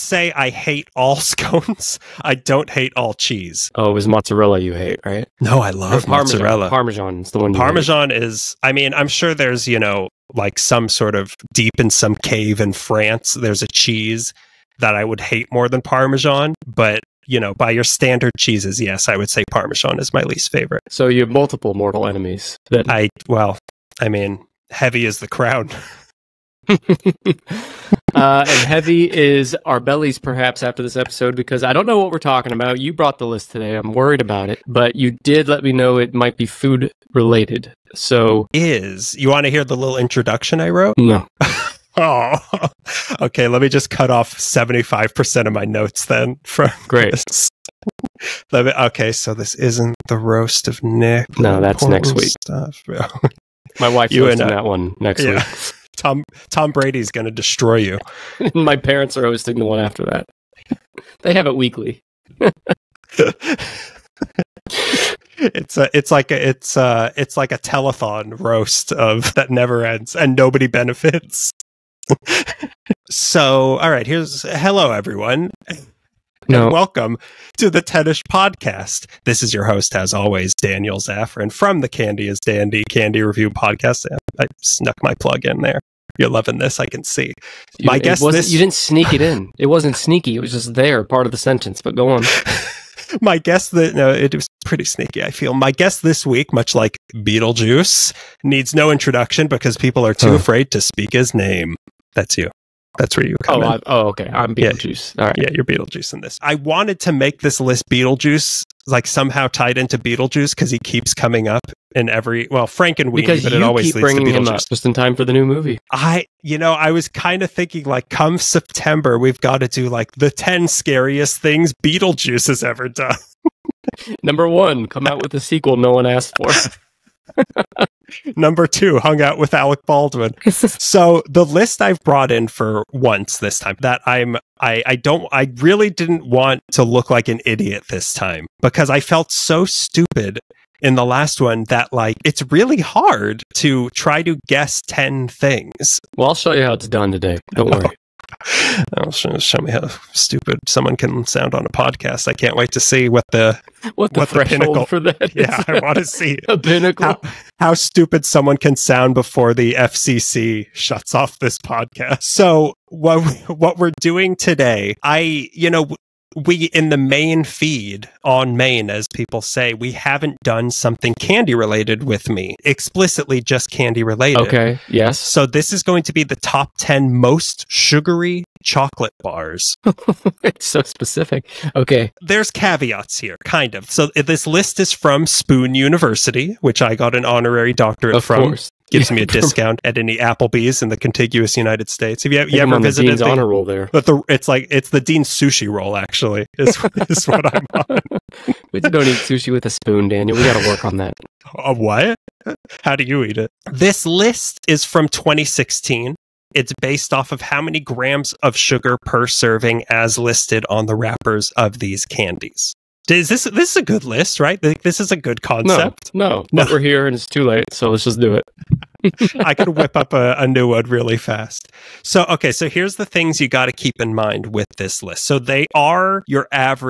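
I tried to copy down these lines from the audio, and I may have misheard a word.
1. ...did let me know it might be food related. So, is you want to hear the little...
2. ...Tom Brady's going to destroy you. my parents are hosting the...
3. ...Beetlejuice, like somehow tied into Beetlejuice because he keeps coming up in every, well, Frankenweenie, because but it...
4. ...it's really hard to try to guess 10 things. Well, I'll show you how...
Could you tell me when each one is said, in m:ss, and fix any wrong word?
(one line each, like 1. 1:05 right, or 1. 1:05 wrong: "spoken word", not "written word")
1. 0:35 right
2. 0:56 right
3. 1:47 right
4. 2:22 right.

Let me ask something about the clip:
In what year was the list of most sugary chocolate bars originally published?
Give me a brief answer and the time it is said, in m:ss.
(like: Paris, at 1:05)
2016, at 3:25.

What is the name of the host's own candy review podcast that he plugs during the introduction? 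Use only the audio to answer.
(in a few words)
Candy is Dandy.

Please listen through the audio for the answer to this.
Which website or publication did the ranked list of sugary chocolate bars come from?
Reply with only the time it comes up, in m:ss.
3:05.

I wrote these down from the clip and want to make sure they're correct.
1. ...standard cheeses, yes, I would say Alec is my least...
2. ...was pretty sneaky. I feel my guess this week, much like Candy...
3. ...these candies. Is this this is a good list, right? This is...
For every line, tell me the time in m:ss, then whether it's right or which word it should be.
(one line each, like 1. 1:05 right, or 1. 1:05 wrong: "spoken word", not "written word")
1. 0:17 wrong: "Parmesan", not "Alec"
2. 1:34 wrong: "Beetlejuice", not "Candy"
3. 3:31 right.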